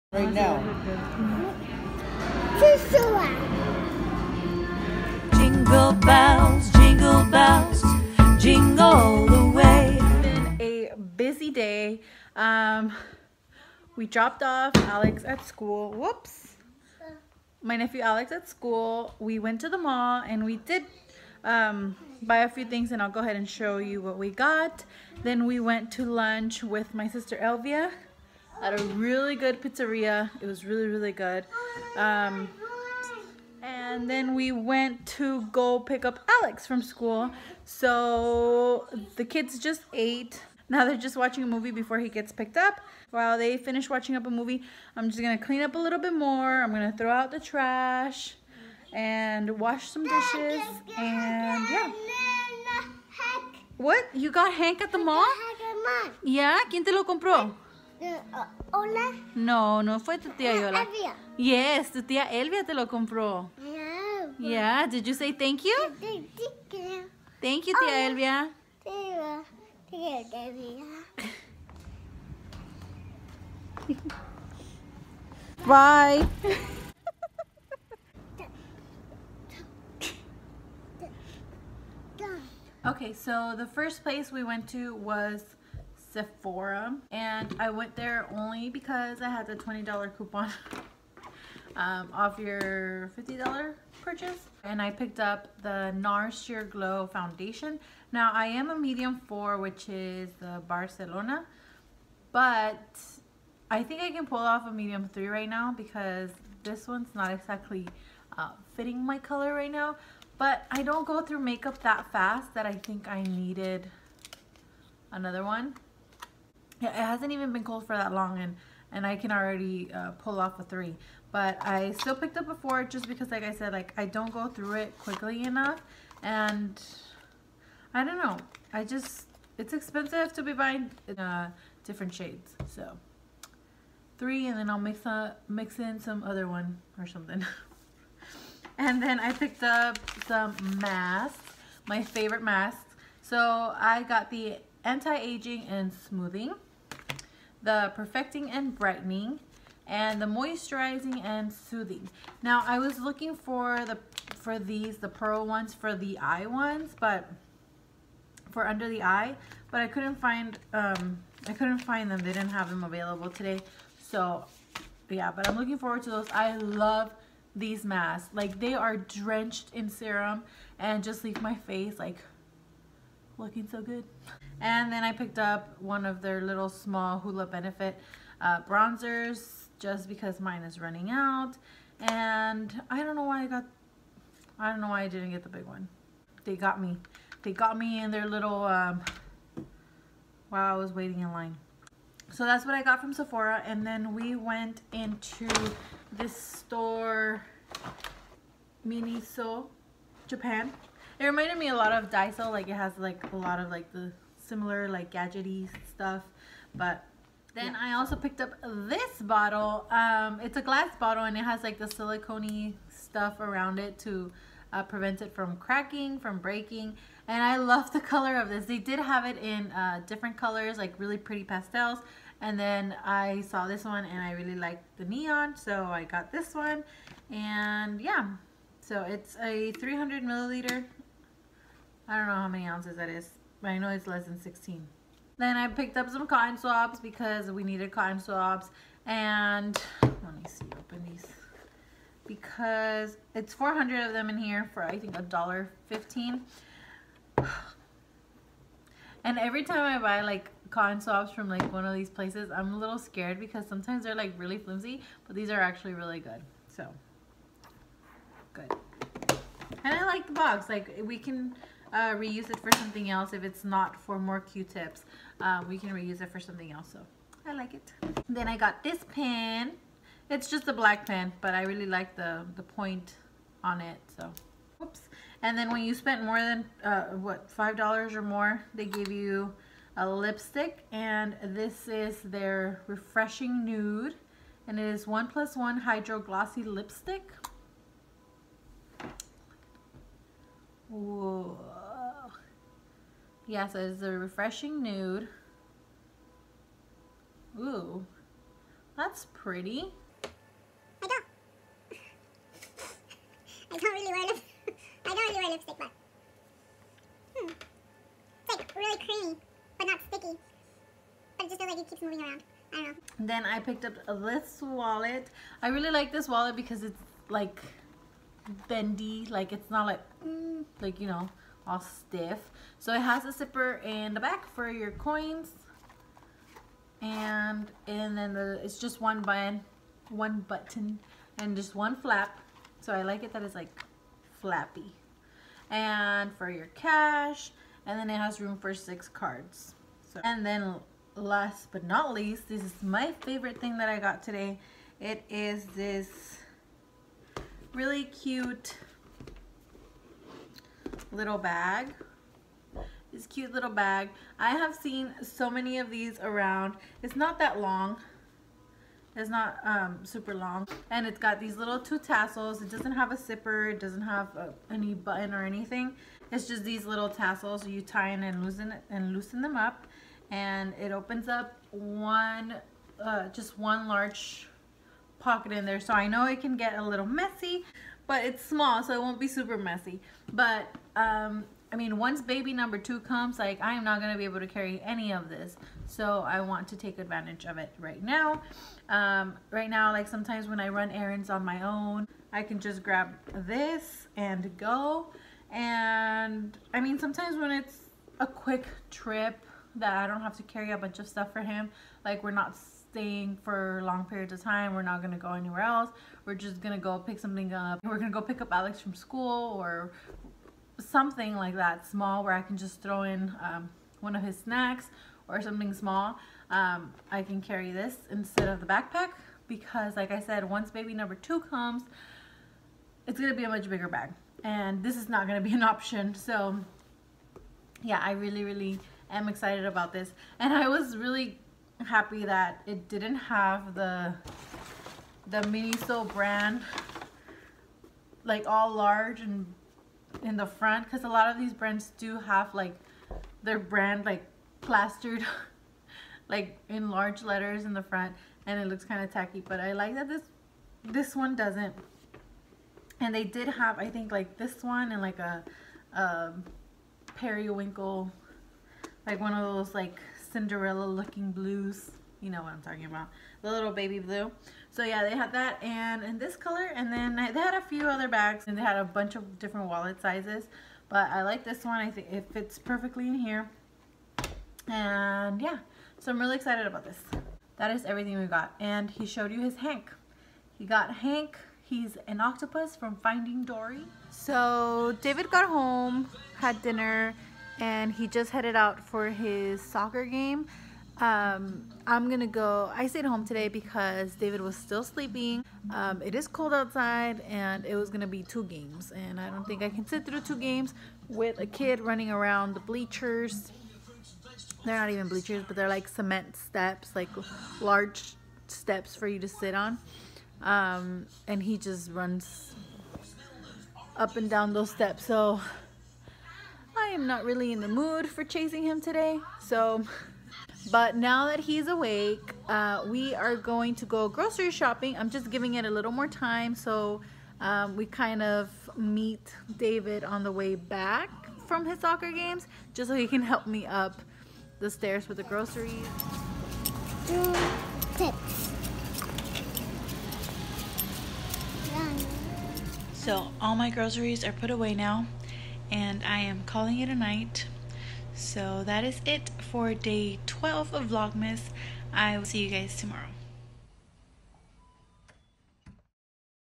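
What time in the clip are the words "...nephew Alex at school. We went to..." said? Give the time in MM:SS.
00:17.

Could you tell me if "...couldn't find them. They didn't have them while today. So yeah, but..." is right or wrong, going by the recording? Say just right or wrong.
wrong.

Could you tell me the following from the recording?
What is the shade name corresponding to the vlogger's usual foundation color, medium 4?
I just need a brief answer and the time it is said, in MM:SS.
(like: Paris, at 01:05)
Barcelona, at 01:40.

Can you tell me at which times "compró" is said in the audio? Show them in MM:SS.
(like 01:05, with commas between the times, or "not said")
00:57, 01:02.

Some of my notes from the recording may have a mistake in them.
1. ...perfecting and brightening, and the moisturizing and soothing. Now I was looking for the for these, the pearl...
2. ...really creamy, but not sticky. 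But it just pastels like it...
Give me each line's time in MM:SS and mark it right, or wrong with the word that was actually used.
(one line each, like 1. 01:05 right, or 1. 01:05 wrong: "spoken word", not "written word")
1. 02:27 right
2. 05:08 wrong: "feels", not "pastels".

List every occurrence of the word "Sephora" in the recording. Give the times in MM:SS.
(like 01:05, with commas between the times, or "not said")
01:26, 03:13.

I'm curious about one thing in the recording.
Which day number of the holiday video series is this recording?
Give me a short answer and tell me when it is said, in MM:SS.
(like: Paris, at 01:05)
12, at 09:09.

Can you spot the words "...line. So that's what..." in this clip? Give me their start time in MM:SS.
03:11.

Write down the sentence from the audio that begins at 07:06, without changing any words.
So yeah, I really, really am excited about this.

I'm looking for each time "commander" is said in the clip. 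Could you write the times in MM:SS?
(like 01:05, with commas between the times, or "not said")
not said.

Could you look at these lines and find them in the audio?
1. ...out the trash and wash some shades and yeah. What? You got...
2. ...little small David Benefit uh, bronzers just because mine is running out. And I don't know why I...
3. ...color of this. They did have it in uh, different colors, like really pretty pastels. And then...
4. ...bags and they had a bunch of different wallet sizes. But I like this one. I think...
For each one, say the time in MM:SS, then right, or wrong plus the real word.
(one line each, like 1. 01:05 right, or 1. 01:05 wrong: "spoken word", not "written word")
1. 00:47 wrong: "dishes", not "shades"
2. 02:56 wrong: "Hoola", not "David"
3. 03:37 right
4. 07:48 right.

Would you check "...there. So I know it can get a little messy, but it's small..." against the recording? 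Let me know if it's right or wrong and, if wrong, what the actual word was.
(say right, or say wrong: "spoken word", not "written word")
right.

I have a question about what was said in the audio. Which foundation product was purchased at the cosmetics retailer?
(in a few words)
NARS Sheer Glow.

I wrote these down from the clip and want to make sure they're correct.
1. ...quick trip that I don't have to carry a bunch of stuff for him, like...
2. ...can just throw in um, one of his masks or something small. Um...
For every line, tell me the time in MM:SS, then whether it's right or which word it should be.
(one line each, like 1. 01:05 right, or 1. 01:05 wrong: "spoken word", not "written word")
1. 06:38 right
2. 06:52 wrong: "snacks", not "masks".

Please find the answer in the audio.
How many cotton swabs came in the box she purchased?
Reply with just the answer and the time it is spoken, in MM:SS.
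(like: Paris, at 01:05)
400, at 04:03.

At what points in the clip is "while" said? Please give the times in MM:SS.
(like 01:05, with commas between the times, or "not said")
00:43, 03:10.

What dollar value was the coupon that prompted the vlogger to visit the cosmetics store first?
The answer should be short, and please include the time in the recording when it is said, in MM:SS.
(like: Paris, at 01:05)
$20, at 01:29.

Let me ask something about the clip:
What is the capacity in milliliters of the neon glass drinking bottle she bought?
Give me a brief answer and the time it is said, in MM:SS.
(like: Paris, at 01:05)
300, at 03:49.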